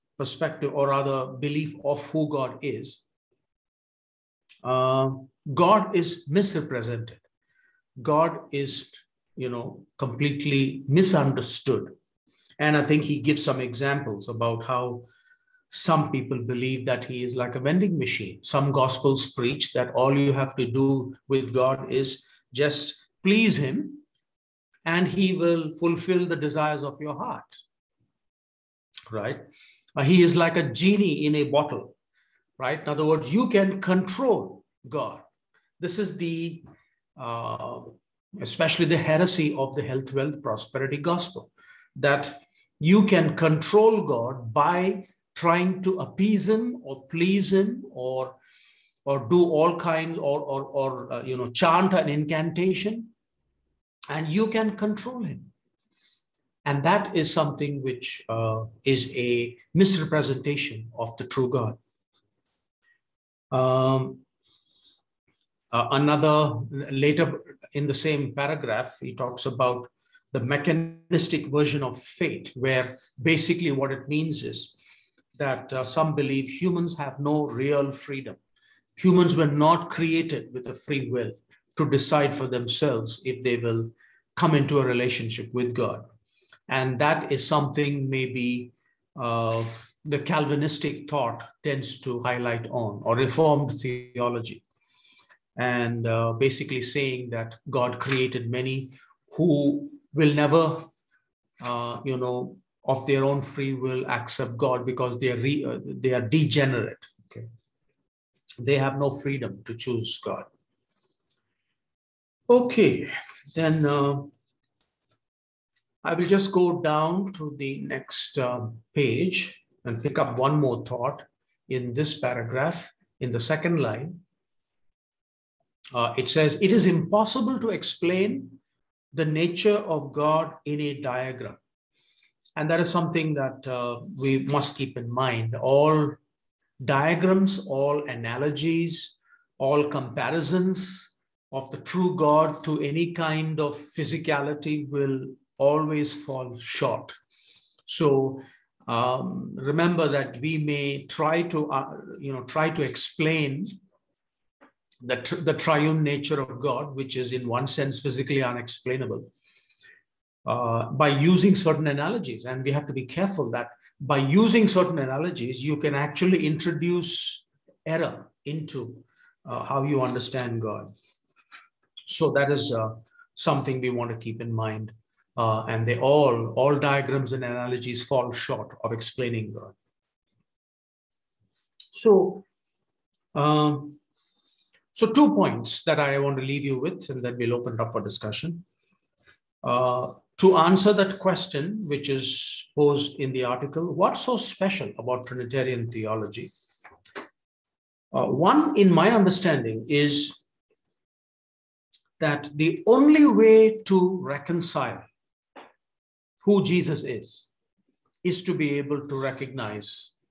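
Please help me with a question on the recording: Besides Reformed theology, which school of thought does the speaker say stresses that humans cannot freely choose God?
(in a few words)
Calvinistic thought.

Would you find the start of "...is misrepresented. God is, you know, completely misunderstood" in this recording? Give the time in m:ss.
0:05.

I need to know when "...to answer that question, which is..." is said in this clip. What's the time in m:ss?
3:10.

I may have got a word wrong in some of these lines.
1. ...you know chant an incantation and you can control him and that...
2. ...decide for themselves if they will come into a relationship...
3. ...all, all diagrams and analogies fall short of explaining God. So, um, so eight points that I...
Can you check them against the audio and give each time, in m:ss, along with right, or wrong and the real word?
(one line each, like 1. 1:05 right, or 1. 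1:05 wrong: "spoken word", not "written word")
1. 0:51 right
2. 1:21 right
3. 2:55 wrong: "two", not "eight".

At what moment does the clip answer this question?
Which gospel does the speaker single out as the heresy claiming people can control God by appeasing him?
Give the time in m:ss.
0:39.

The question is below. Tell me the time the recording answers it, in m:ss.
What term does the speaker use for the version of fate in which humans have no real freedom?
1:10.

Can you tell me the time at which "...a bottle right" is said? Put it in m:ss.
0:31.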